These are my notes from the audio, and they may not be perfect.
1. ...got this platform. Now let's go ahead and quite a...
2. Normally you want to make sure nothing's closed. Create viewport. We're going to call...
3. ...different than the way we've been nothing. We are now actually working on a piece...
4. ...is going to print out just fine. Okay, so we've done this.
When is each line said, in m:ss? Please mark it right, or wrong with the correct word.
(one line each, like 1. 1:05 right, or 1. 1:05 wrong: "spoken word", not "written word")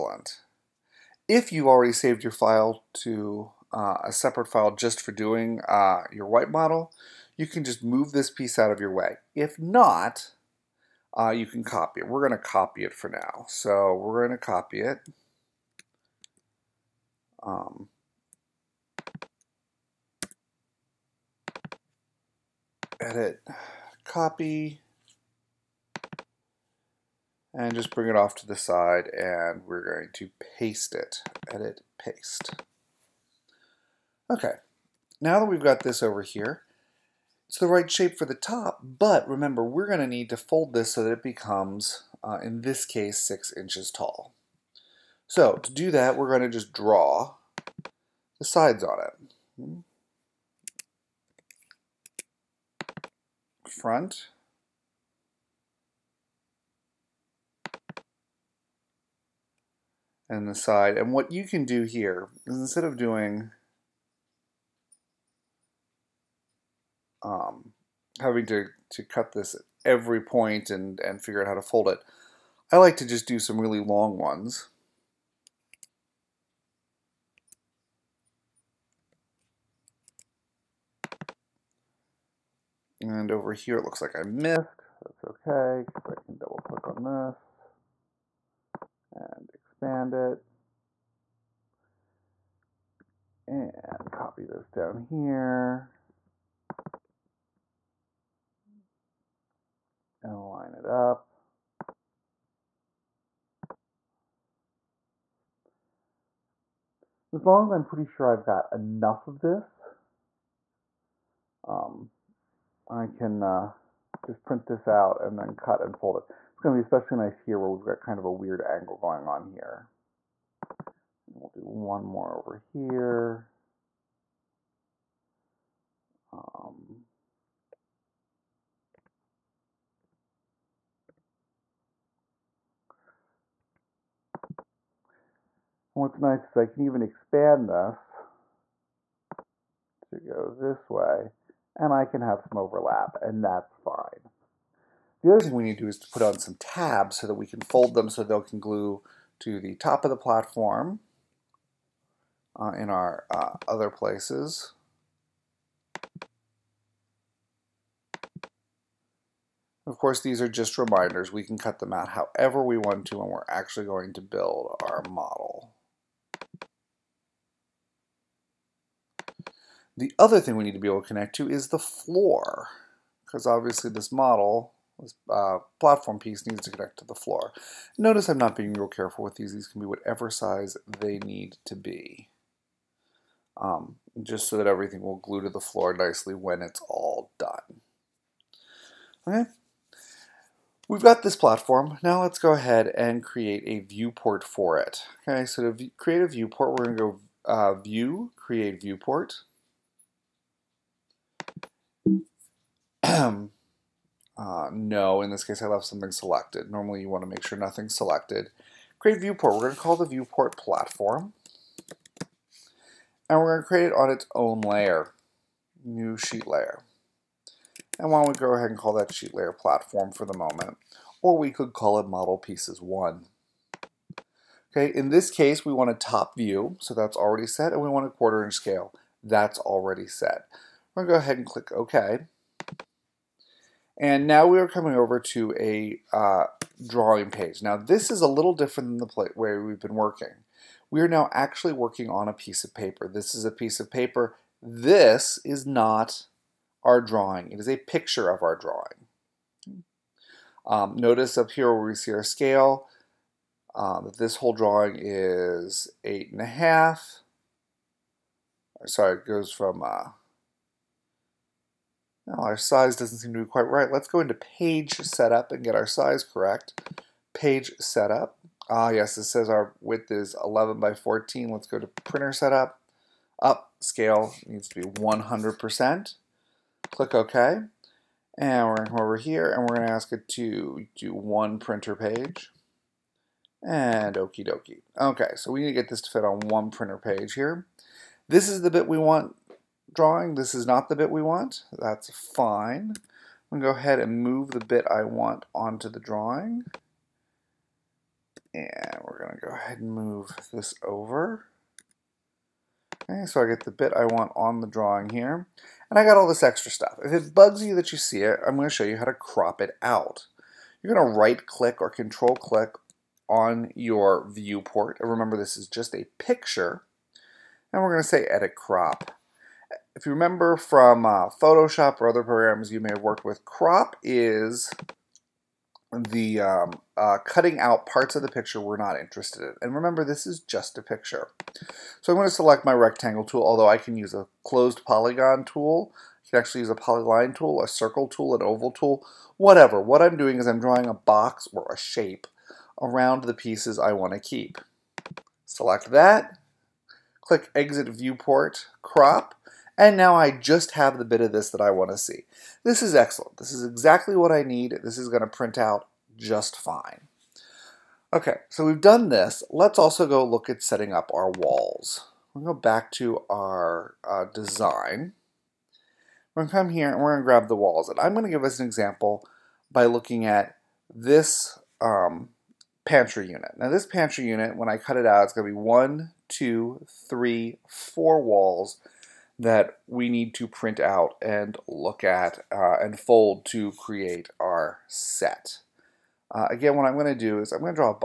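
1. 3:11 wrong: "create", not "quite"
2. 3:26 wrong: "selected", not "closed"
3. 3:58 wrong: "working", not "nothing"
4. 5:54 right.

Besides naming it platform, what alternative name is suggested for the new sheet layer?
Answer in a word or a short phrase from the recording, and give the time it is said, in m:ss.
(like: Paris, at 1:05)
model pieces 1, at 3:42.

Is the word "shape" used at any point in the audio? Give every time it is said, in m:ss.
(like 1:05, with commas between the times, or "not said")
0:37, 5:41.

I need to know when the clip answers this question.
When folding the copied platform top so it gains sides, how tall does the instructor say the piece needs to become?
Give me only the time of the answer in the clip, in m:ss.
0:43.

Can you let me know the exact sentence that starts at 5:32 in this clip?
So I'm going to select my rectangle tool, although I can use a closed polygon tool.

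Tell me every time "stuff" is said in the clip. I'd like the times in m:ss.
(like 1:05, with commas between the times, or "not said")
5:06.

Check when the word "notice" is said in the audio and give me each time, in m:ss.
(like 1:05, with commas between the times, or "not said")
2:57, 4:10.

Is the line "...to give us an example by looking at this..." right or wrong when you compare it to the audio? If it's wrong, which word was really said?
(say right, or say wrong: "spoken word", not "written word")
right.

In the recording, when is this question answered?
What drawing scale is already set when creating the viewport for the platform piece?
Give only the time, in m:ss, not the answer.
3:48.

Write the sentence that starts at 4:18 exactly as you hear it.
Sorry, it goes from uh, now our size doesn't seem to be quite right.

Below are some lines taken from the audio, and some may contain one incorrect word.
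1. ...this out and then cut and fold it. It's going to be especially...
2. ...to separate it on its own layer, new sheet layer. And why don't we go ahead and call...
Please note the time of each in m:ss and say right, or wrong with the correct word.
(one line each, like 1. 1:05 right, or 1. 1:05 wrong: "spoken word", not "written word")
1. 1:54 right
2. 3:33 wrong: "create", not "separate".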